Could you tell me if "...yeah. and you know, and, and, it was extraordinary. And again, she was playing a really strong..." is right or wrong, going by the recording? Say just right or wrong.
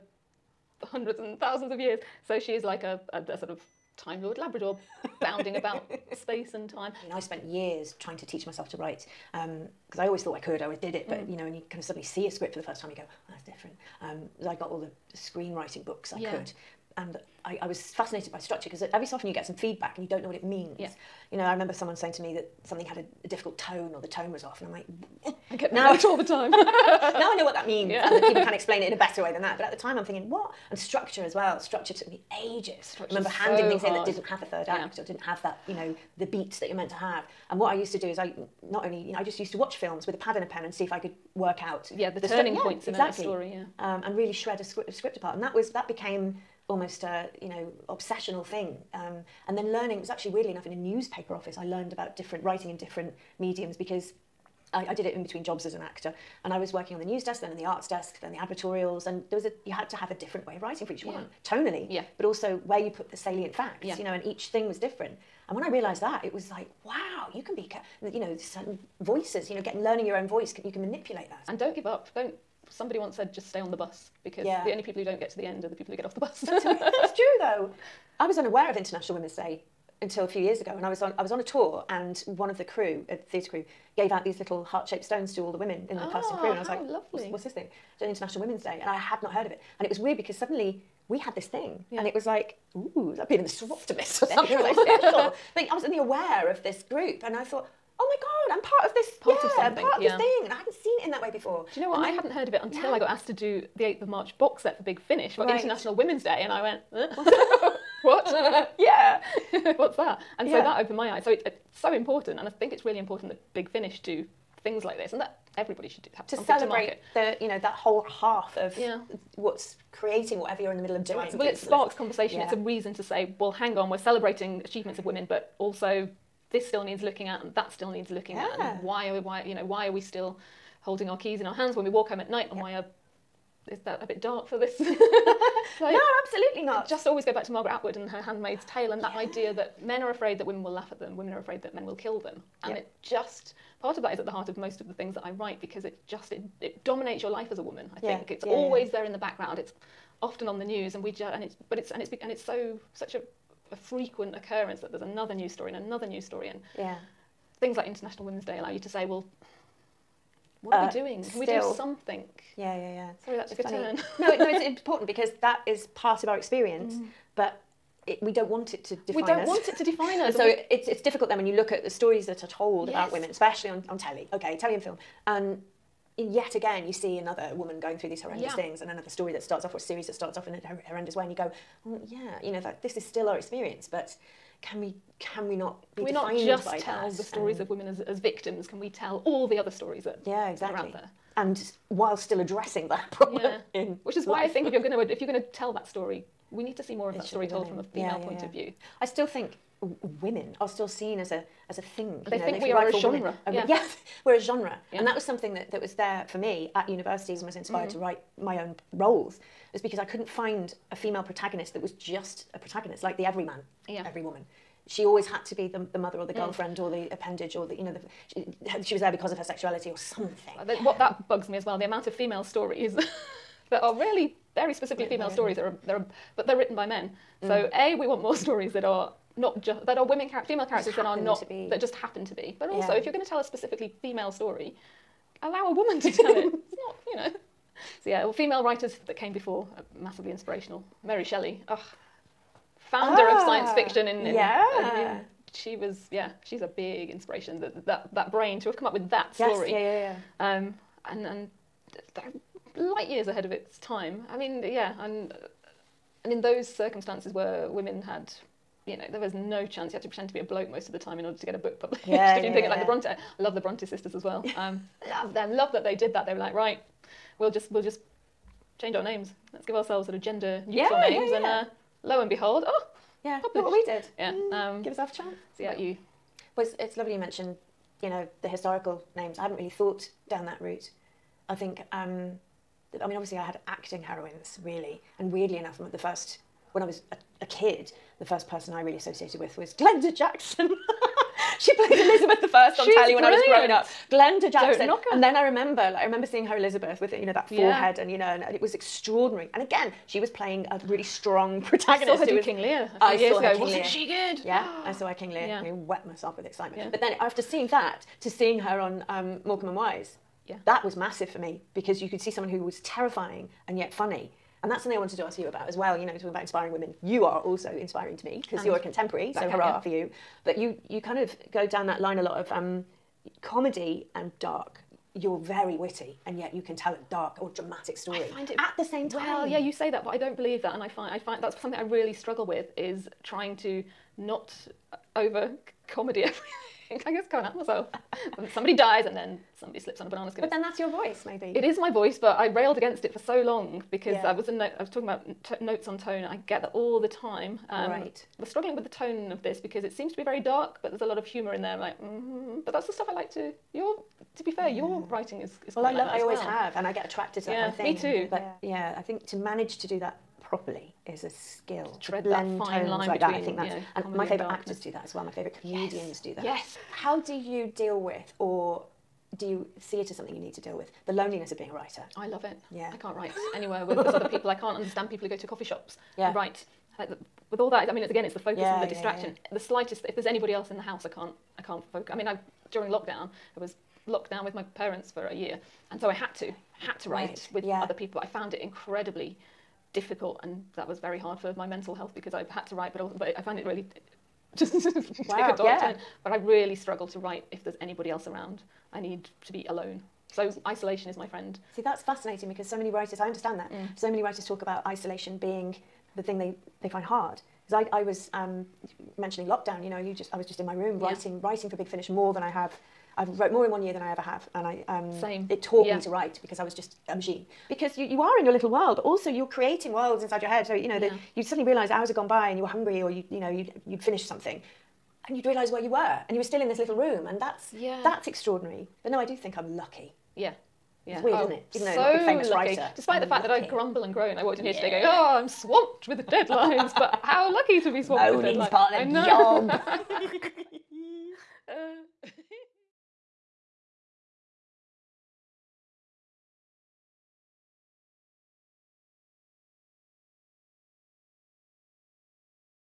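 right.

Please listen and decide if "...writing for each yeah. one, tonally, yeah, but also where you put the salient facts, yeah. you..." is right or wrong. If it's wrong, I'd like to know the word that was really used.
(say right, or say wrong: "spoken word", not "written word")
right.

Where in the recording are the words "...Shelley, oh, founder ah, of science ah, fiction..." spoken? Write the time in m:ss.
4:01.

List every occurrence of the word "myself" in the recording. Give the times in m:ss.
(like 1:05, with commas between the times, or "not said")
0:08, 5:06, 5:37.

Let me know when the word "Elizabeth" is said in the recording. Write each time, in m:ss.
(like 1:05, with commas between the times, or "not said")
4:51, 4:56.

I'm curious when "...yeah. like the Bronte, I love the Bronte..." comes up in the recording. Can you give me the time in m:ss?
4:22.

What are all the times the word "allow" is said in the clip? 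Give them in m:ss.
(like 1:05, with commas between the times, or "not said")
2:38, 3:55.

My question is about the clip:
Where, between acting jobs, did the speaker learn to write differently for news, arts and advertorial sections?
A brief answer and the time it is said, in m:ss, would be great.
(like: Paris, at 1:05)
A newspaper office, at 0:50.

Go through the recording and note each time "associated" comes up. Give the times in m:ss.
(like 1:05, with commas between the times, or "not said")
4:48.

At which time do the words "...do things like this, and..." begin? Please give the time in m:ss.
1:54.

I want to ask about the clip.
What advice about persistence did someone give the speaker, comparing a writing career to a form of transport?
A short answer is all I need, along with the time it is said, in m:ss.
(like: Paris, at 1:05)
Stay on the bus, at 1:13.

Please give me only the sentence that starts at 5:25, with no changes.
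You're very witty, and yet you can tell a dark or dramatic story.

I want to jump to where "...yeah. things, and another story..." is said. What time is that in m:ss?
2:58.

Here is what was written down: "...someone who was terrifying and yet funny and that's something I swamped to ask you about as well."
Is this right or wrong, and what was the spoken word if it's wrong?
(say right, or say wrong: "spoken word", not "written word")
wrong: "wanted", not "swamped".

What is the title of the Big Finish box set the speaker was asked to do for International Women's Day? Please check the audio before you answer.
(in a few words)
8th of March.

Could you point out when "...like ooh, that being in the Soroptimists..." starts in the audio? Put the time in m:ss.
1:32.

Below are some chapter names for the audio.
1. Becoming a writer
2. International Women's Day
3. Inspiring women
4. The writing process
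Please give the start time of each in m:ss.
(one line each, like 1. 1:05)
1. 0:06
2. 1:17
3. 3:57
4. 6:06.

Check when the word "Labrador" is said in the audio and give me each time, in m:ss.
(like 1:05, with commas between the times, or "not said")
0:04.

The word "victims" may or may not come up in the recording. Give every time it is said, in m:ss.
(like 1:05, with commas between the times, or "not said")
3:08.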